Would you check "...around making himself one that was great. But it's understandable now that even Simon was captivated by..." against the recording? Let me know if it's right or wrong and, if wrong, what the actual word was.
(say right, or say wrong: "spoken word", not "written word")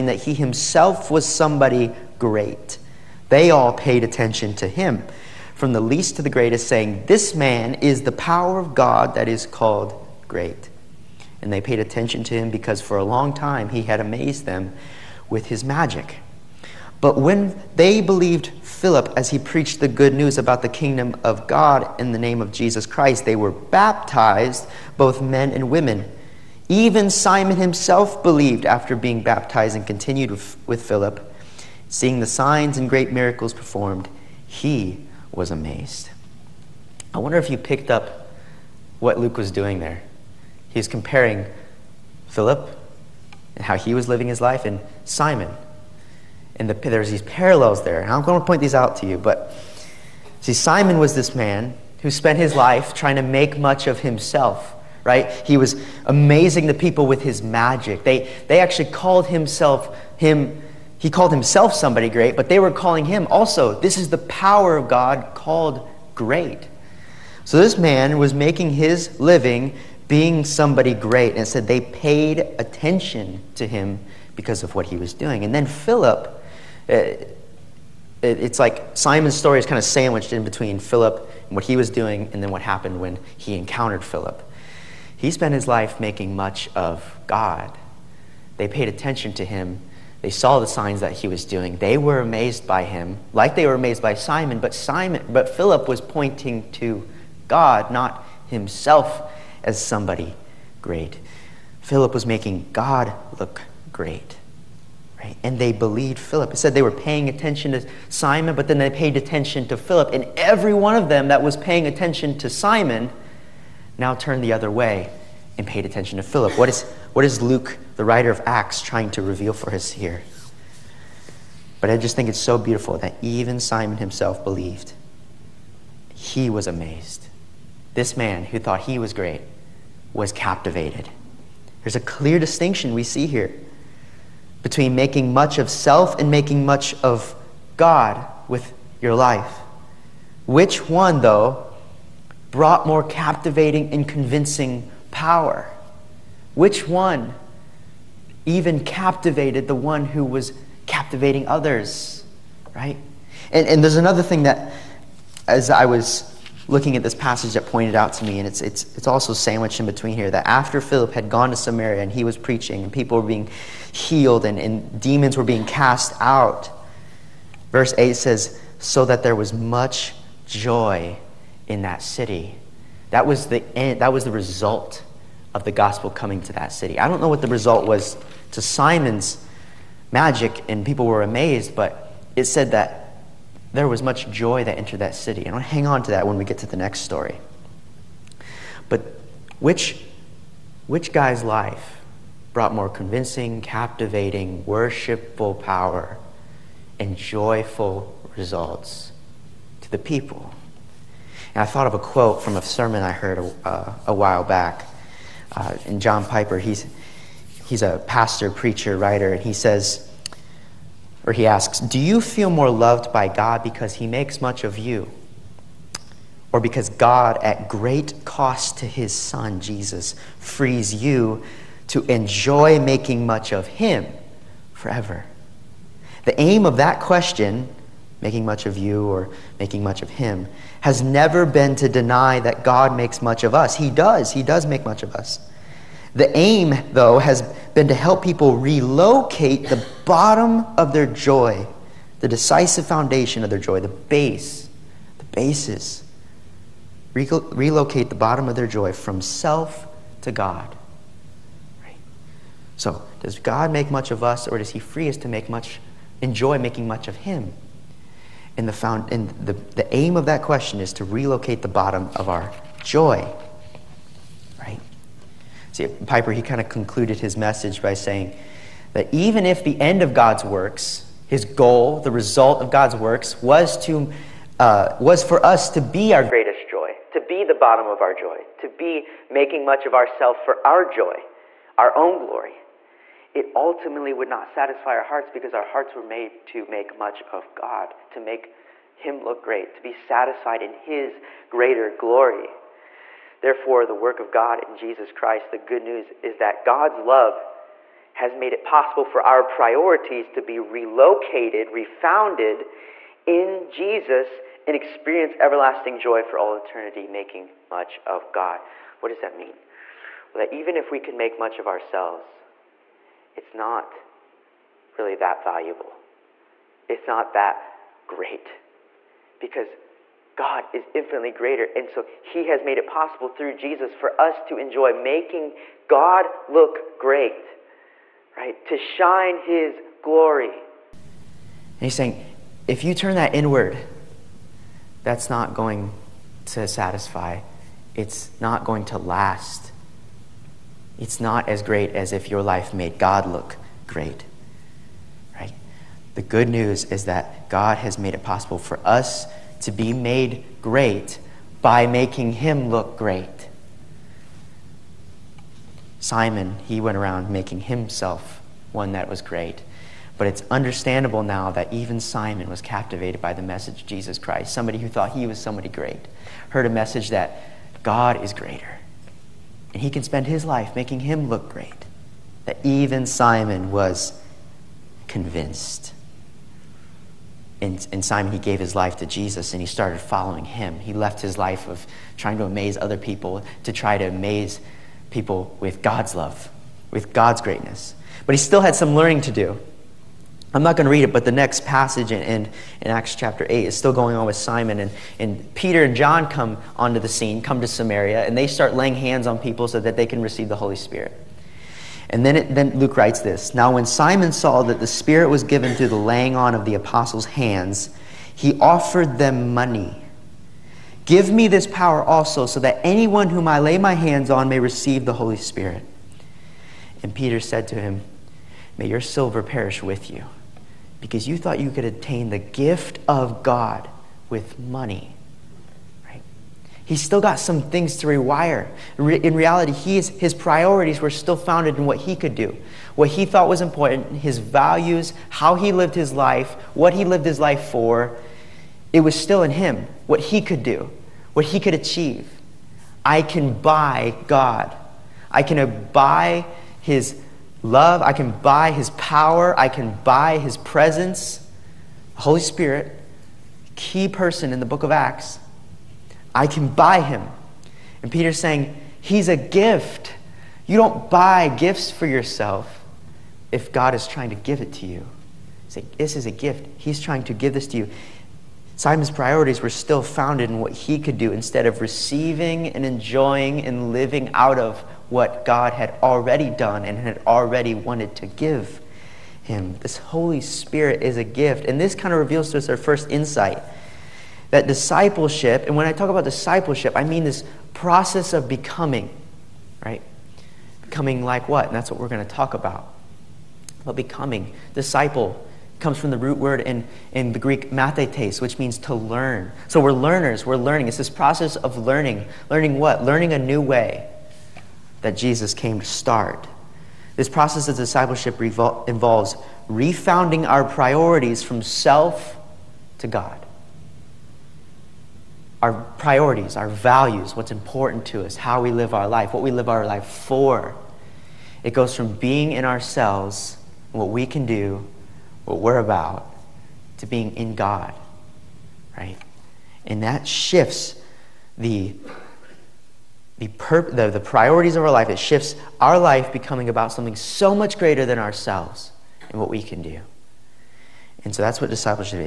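right.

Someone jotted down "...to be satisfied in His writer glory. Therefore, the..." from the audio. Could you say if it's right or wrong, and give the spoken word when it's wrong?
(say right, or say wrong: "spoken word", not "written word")
wrong: "greater", not "writer".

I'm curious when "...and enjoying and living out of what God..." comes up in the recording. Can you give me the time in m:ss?
7:52.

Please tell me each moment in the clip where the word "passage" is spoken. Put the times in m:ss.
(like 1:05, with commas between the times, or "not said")
2:37, 6:31.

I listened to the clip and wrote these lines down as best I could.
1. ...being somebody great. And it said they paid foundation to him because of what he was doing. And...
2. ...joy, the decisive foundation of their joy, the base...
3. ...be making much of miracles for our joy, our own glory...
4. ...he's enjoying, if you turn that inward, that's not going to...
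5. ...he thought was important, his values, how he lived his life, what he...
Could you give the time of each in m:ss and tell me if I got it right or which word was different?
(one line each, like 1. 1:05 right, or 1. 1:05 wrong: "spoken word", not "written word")
1. 1:10 wrong: "attention", not "foundation"
2. 4:01 right
3. 4:38 wrong: "ourselves", not "miracles"
4. 5:31 wrong: "saying", not "enjoying"
5. 7:13 right.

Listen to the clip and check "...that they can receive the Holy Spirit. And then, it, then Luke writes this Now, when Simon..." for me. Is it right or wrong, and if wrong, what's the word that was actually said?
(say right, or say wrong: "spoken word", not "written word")
right.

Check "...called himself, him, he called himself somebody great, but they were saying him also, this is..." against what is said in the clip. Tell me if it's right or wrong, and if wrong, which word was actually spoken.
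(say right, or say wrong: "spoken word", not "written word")
wrong: "calling", not "saying".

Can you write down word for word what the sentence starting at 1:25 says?
He spent his life making much of God.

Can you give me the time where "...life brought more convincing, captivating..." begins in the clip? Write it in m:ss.
3:11.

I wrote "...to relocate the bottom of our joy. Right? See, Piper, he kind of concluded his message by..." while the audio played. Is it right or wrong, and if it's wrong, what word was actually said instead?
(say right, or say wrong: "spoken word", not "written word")
right.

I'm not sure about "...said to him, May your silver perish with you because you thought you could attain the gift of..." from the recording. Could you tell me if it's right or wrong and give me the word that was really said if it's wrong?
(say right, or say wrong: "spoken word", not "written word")
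right.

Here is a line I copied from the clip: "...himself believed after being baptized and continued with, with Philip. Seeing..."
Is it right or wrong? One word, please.
right.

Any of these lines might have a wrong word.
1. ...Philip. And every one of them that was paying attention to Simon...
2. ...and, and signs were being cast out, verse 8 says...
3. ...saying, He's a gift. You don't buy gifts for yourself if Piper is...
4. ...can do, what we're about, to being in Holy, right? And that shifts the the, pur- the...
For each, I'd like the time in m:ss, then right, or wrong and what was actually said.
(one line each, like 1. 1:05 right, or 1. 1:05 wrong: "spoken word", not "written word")
1. 1:49 right
2. 2:44 wrong: "demons", not "signs"
3. 7:38 wrong: "God", not "Piper"
4. 8:44 wrong: "God", not "Holy".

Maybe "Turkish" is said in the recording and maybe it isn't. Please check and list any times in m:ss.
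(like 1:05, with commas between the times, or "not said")
not said.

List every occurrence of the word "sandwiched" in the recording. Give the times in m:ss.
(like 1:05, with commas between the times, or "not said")
1:19, 2:39.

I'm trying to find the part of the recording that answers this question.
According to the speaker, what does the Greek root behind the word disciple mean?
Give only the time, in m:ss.
8:18.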